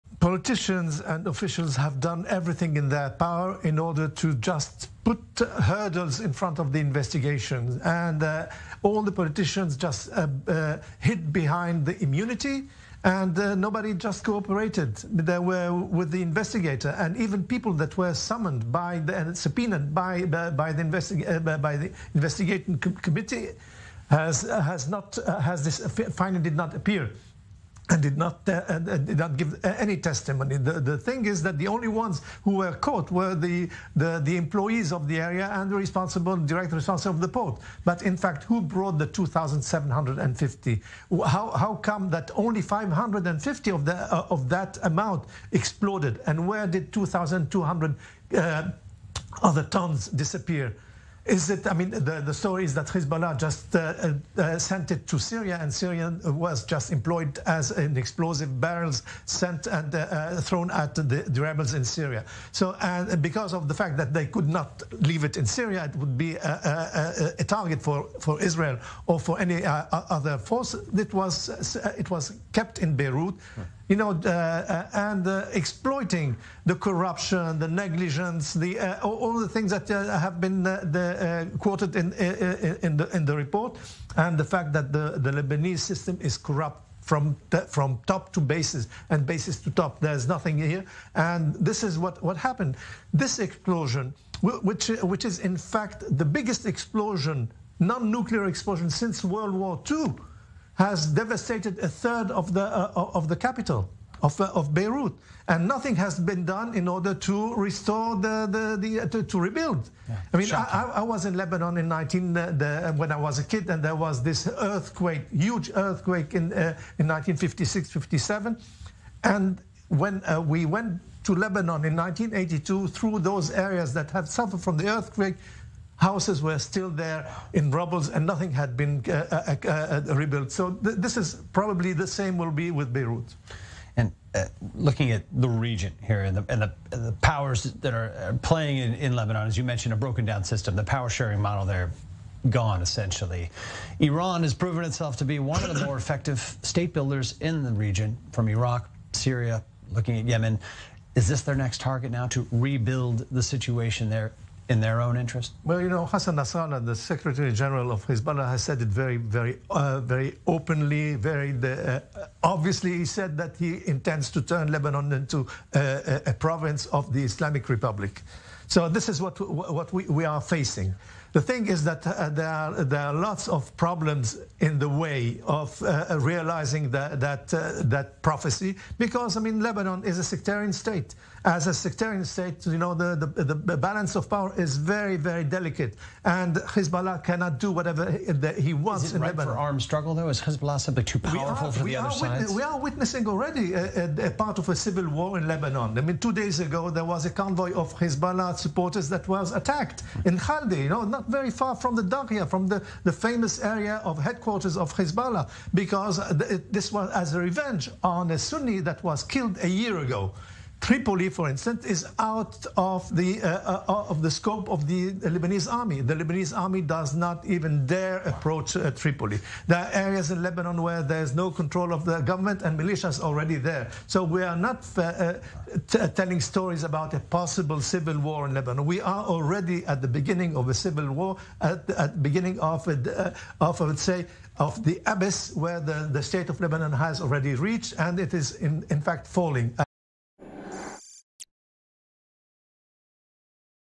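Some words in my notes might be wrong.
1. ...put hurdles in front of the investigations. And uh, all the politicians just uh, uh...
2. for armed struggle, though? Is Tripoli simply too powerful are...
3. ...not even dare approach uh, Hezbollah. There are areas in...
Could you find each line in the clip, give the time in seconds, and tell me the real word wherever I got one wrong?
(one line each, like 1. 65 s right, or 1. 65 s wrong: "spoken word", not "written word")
1. 5 s right
2. 189 s wrong: "Hezbollah", not "Tripoli"
3. 217 s wrong: "Tripoli", not "Hezbollah".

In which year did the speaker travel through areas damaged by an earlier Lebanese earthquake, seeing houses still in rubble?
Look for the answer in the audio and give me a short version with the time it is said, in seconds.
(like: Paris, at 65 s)
1982, at 121 s.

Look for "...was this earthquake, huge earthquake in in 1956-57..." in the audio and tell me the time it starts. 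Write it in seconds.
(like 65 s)
113 s.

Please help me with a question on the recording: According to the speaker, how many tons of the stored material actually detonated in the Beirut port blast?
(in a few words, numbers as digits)
550.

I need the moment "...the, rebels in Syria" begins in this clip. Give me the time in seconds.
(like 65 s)
61 s.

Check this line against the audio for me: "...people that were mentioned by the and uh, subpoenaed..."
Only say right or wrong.
wrong.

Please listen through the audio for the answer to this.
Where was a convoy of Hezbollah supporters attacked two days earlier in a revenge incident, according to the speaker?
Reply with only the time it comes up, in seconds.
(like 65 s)
200 s.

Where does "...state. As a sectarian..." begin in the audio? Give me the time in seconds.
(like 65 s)
180 s.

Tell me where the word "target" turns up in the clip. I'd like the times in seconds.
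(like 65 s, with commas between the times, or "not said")
67 s, 151 s.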